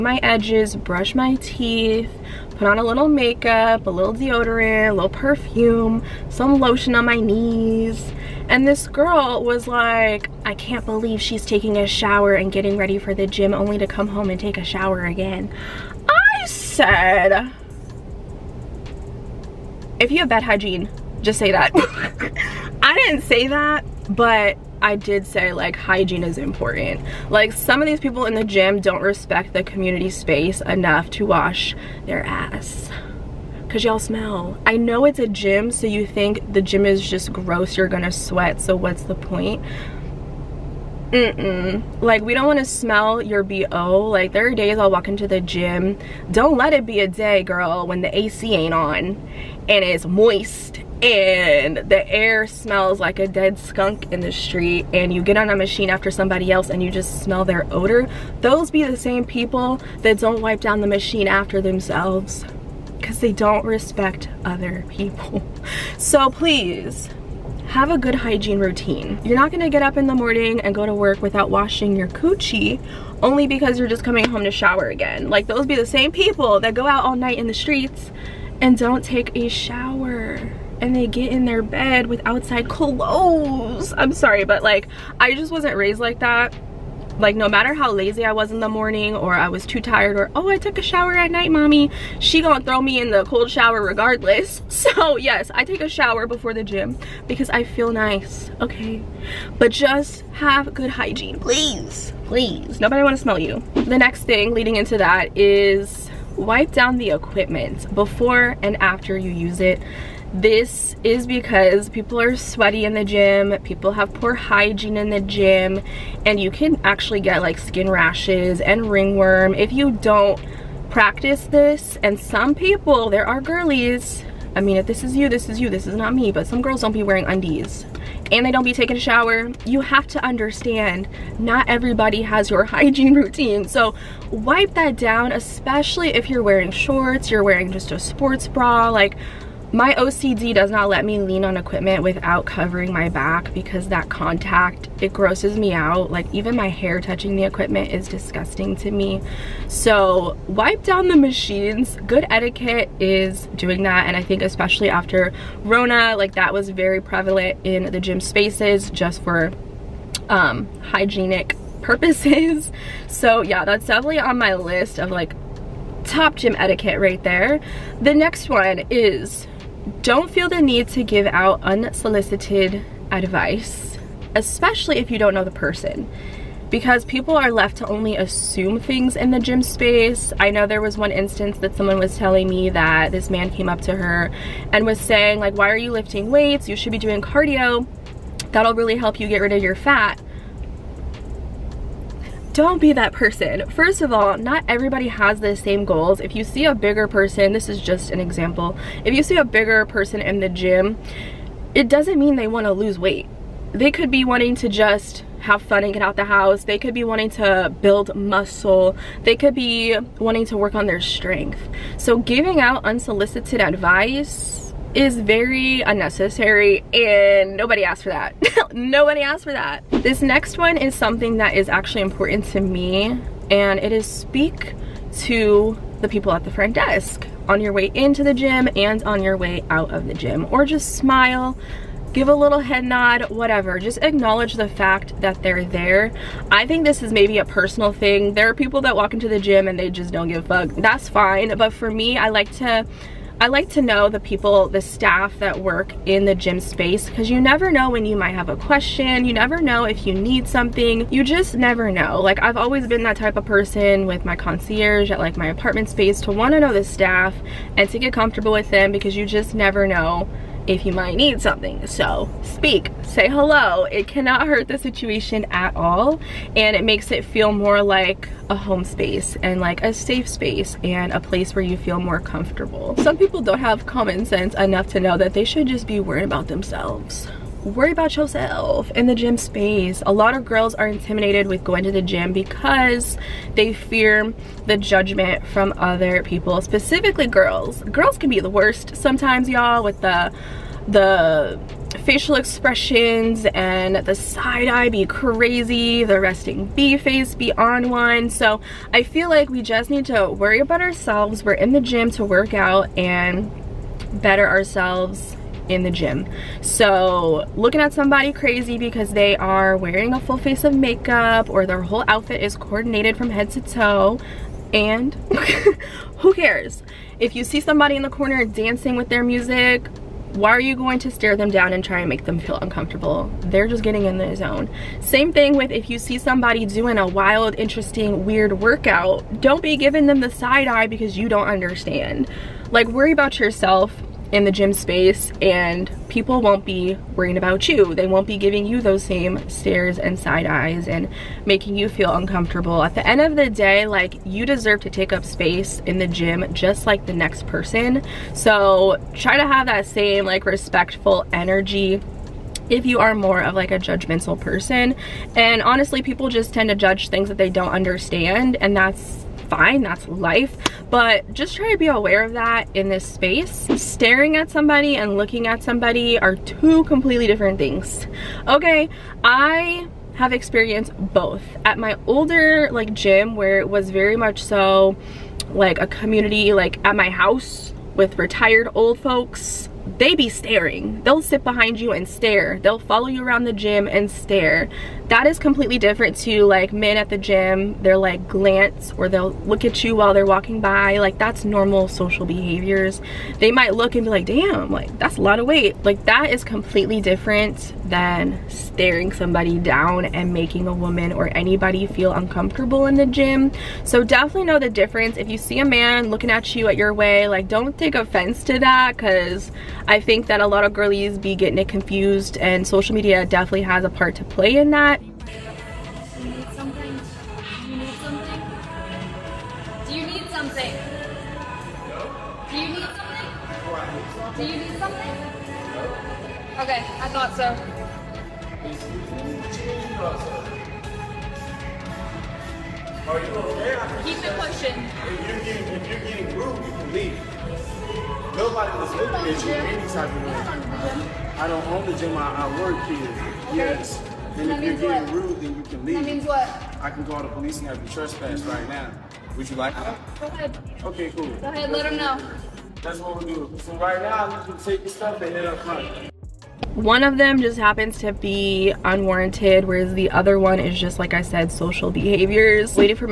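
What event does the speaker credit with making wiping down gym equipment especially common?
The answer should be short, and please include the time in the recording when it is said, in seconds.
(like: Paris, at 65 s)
Rona, at 155 s.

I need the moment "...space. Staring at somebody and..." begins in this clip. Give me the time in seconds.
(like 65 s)
363 s.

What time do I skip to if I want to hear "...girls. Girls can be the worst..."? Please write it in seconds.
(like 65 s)
287 s.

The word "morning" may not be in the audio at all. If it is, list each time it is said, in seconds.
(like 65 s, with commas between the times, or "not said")
70 s, 88 s.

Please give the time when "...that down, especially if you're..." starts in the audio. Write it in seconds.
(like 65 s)
134 s.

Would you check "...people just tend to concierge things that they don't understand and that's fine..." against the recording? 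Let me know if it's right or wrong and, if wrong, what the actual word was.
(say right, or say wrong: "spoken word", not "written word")
wrong: "judge", not "concierge".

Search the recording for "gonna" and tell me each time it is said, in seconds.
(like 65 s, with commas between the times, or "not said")
37 s, 69 s, 92 s.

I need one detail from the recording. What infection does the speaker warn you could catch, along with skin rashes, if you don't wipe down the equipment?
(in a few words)
Ringworm.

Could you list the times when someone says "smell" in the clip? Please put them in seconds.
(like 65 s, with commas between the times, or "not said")
33 s, 42 s, 52 s, 57 s, 103 s.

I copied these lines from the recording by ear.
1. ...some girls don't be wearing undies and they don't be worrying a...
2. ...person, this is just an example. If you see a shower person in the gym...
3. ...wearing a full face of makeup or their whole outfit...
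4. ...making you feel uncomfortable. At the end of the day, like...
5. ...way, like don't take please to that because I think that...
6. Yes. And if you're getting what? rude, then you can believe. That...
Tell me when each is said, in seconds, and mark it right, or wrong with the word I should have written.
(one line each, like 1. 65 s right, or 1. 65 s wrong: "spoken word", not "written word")
1. 126 s wrong: "taking", not "worrying"
2. 197 s wrong: "bigger", not "shower"
3. 309 s right
4. 341 s right
5. 406 s wrong: "offense", not "please"
6. 443 s wrong: "leave", not "believe".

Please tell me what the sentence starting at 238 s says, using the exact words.
There are people that walk into the gym and they just don't give a fuck.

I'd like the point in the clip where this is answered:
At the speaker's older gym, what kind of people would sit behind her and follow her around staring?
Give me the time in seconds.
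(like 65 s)
378 s.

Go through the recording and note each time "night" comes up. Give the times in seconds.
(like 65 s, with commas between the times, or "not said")
77 s, 91 s.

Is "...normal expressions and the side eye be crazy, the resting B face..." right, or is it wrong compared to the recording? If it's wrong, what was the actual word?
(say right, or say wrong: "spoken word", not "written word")
wrong: "facial", not "normal".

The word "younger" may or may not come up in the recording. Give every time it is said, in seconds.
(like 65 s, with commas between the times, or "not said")
not said.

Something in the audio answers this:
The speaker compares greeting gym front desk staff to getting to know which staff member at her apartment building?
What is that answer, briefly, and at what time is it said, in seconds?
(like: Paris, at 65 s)
Concierge, at 254 s.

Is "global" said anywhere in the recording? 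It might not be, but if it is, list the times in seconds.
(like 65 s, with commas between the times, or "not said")
not said.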